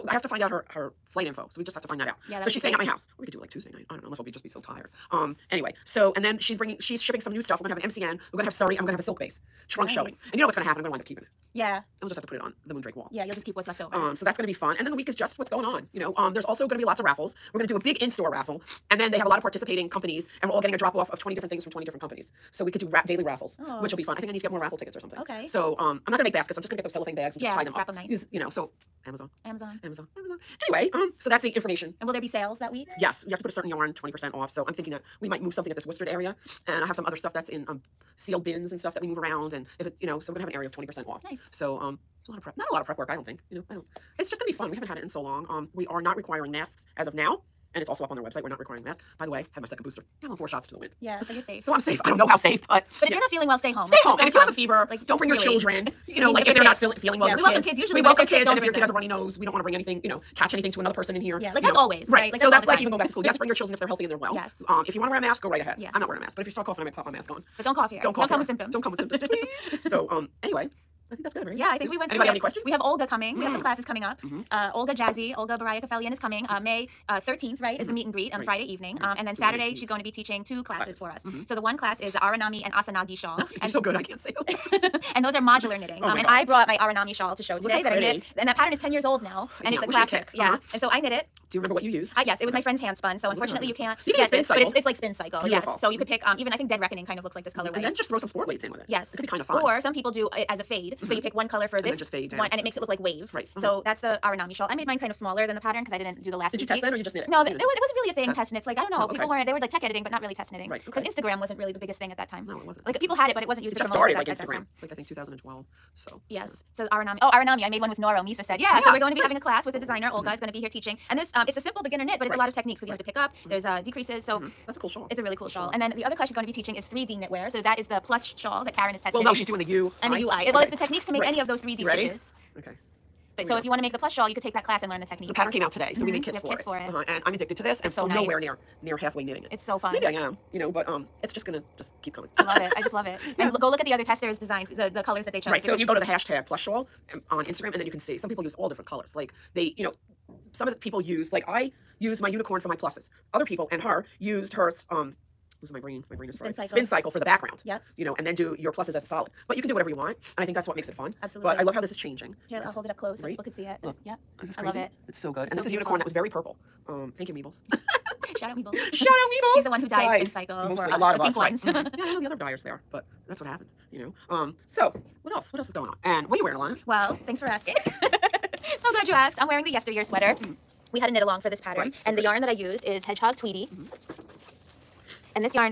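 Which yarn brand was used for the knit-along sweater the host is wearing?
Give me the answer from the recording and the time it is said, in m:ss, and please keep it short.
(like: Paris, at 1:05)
Hedgehog Tweedy, at 3:03.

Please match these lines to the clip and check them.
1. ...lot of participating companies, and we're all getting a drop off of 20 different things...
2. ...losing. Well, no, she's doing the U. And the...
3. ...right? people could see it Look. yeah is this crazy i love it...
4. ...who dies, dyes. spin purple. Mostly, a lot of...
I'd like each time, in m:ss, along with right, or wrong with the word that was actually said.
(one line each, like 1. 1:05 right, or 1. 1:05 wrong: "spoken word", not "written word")
1. 0:19 right
2. 2:08 wrong: "testing", not "losing"
3. 2:43 right
4. 2:49 wrong: "cycle", not "purple".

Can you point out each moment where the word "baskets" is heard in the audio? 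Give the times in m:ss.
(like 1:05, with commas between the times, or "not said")
0:26.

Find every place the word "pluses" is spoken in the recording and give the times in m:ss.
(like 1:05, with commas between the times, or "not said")
2:32, 2:38.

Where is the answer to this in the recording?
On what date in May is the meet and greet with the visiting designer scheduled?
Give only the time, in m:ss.
1:16.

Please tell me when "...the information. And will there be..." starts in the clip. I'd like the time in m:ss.
0:31.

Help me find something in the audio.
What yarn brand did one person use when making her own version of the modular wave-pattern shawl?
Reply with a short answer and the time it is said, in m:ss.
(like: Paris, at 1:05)
Noro, at 1:57.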